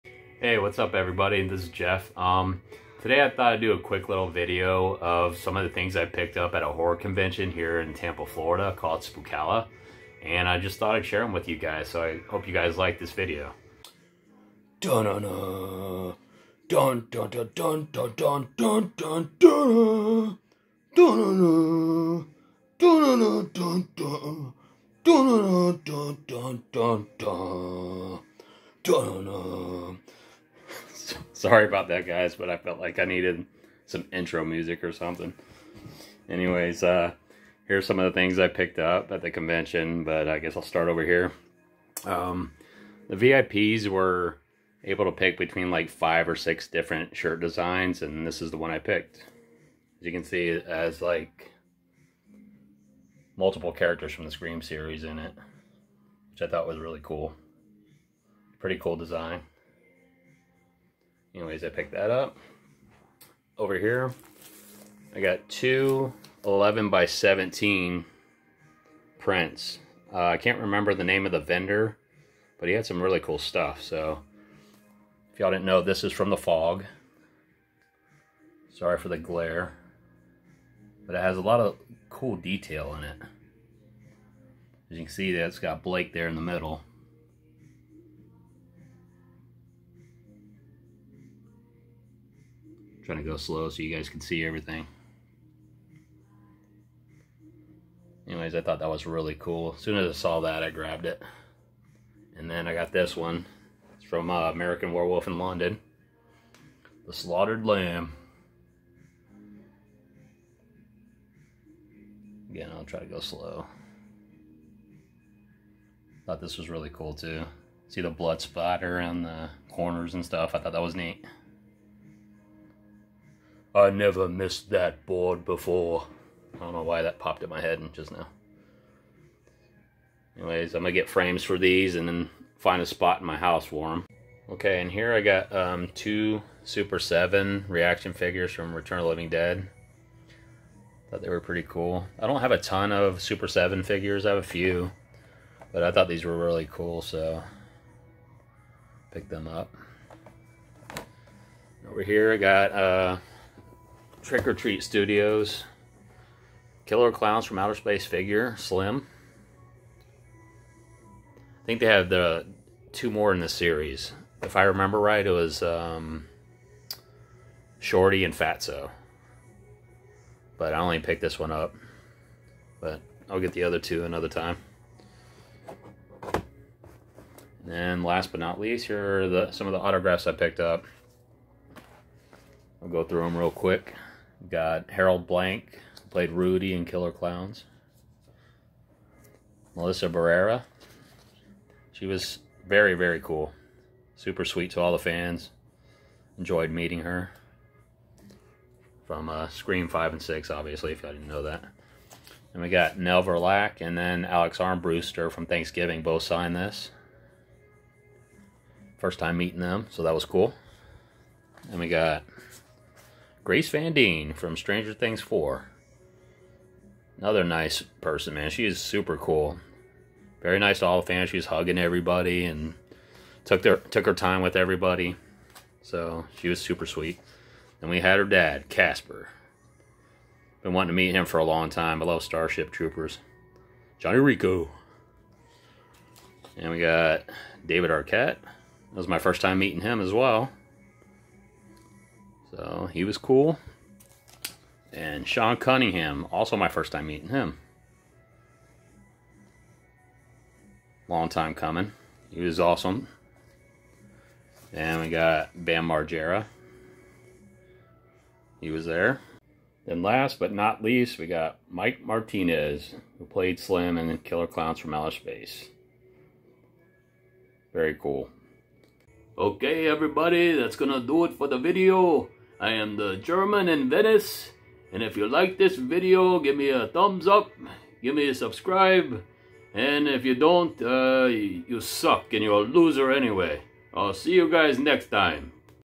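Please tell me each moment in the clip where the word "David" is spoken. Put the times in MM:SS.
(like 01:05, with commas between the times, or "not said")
03:57.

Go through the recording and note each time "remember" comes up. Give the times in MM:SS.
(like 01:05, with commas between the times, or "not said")
01:10, 02:44.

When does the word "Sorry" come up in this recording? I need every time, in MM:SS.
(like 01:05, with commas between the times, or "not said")
00:31, 01:18.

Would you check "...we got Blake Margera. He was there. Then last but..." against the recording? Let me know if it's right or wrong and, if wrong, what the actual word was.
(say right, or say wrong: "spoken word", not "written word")
wrong: "Bam", not "Blake".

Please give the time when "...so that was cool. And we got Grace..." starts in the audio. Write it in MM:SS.
03:29.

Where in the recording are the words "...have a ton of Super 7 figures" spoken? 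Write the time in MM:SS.
02:22.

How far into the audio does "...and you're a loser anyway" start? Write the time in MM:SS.
04:42.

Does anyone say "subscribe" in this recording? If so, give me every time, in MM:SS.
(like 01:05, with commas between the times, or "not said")
04:38.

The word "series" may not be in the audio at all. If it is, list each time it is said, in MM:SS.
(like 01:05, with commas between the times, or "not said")
00:54, 02:43.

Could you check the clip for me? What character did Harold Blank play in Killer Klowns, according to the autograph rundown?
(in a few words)
Rudy.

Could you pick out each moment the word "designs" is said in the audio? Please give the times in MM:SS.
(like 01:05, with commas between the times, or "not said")
00:47, 00:58.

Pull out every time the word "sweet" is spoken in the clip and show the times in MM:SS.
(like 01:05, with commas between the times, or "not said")
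03:14, 03:46.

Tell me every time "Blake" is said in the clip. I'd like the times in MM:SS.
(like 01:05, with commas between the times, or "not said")
01:25.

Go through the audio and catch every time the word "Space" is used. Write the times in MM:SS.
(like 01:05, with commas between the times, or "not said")
02:37, 04:25.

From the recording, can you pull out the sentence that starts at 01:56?
Thought this was really cool too.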